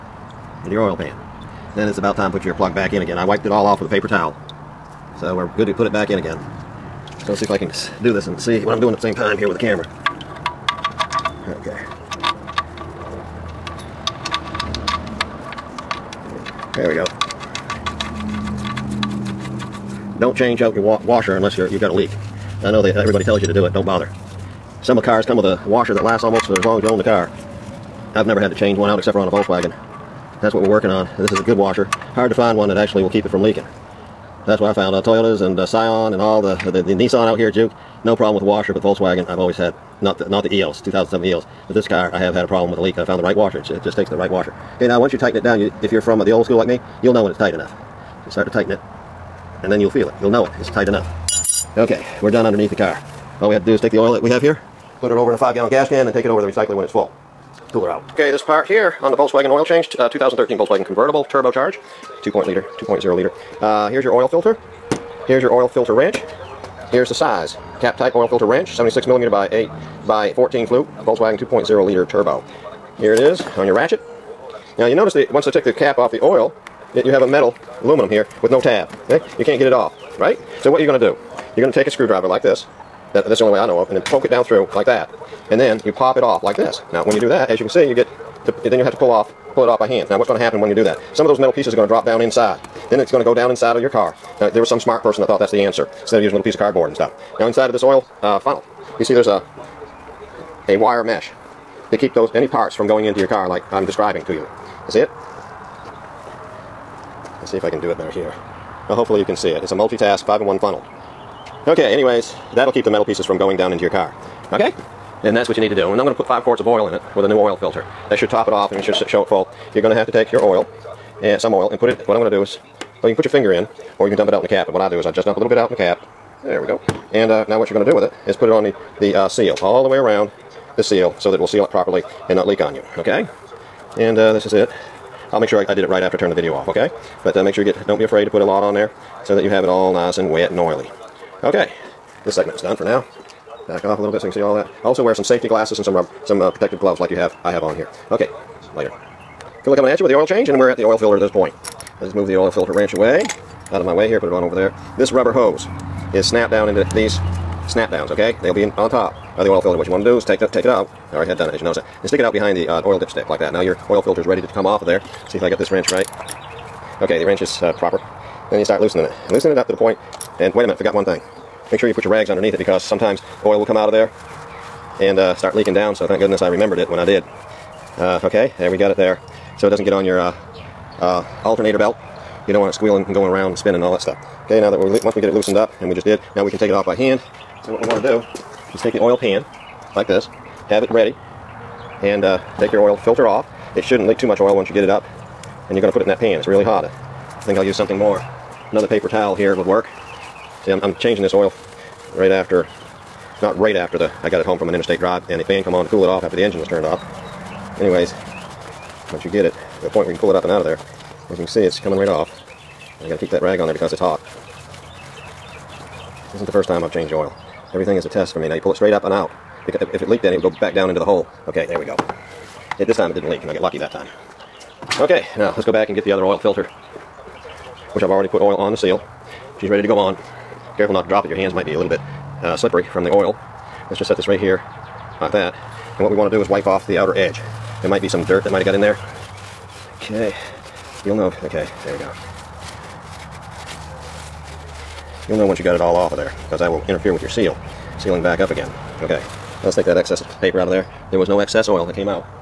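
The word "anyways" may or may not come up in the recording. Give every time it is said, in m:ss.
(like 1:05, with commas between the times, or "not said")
1:51, 3:27.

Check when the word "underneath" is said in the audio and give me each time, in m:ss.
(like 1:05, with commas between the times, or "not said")
0:52, 2:52.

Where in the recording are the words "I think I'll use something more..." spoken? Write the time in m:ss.
3:16.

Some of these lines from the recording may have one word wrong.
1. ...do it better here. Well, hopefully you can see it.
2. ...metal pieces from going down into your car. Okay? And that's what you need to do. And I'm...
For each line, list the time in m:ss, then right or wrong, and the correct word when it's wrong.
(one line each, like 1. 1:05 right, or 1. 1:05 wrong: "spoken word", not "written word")
1. 1:47 right
2. 1:52 right.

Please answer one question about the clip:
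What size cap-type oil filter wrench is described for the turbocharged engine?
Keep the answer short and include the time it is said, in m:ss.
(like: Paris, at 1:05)
76 millimeter, at 1:08.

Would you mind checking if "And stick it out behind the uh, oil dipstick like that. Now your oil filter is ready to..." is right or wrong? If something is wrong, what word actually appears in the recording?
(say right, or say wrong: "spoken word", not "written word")
right.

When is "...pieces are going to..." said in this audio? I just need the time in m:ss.
1:31.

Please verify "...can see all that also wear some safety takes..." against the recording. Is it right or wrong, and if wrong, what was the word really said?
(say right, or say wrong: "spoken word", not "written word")
wrong: "glasses", not "takes".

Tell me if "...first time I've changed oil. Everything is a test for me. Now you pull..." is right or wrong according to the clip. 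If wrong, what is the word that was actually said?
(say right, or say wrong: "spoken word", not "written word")
right.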